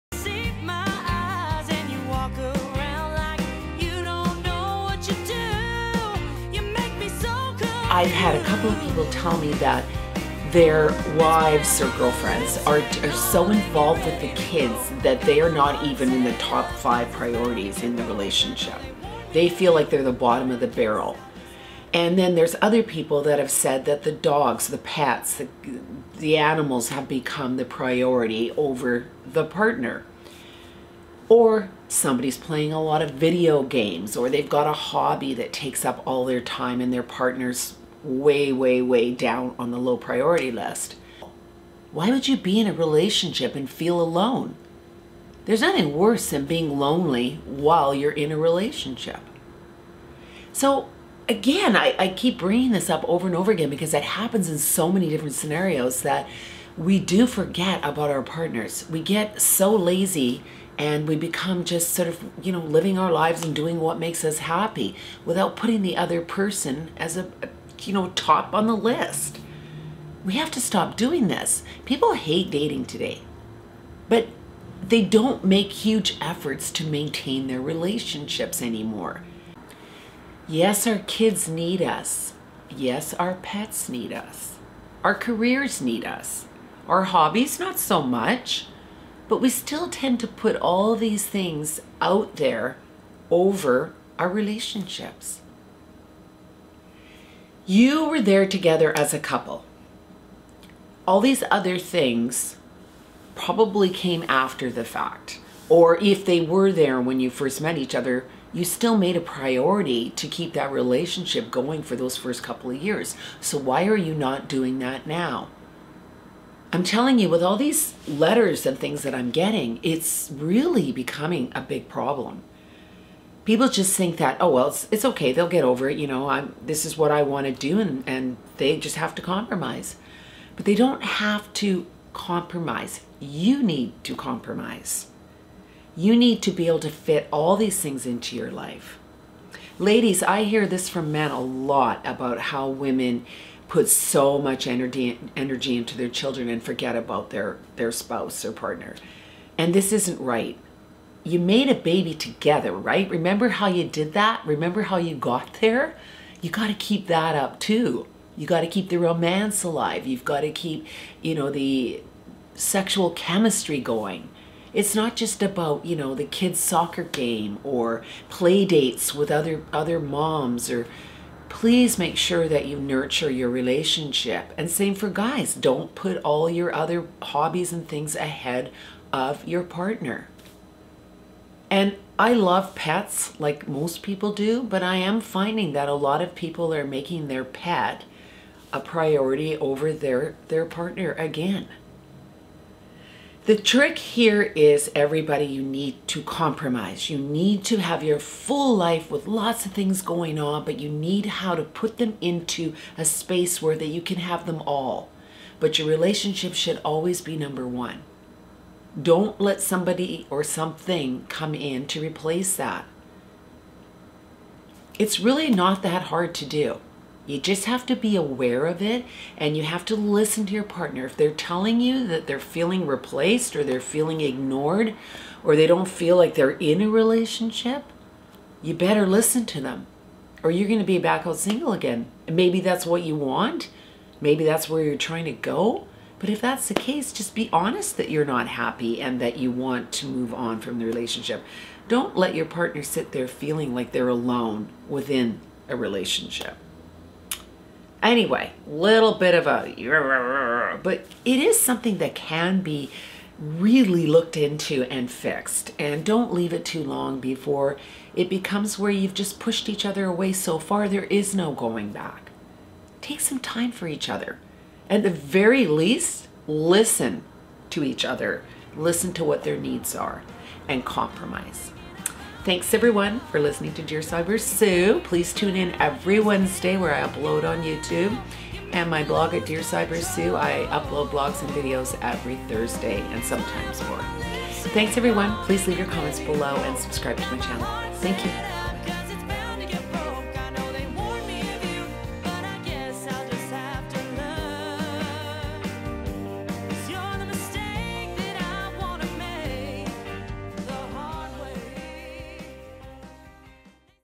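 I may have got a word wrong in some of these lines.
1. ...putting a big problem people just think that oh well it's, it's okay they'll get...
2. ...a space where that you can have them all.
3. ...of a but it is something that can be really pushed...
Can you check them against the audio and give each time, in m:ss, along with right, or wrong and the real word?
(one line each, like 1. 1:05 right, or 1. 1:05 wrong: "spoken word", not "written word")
1. 2:00 wrong: "becoming", not "putting"
2. 3:22 right
3. 4:09 wrong: "looked", not "pushed".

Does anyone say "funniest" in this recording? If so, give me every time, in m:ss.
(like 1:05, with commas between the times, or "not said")
not said.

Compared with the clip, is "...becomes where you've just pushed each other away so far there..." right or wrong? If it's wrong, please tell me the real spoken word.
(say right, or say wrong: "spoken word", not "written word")
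right.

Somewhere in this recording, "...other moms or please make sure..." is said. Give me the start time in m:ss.
2:49.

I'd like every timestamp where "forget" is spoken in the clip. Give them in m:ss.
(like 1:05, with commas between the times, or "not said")
0:57, 2:26.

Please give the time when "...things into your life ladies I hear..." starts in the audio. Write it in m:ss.
2:17.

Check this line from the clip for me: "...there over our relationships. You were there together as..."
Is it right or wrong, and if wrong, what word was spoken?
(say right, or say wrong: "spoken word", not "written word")
right.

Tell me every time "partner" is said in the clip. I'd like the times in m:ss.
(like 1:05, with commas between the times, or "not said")
0:29, 0:37, 0:58, 2:28, 2:59, 3:10, 3:40, 4:02.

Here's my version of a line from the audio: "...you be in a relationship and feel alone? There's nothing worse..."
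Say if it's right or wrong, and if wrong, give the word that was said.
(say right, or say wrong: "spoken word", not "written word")
right.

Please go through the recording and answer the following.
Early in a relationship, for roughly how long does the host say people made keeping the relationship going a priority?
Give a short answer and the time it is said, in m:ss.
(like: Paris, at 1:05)
first couple of years, at 1:52.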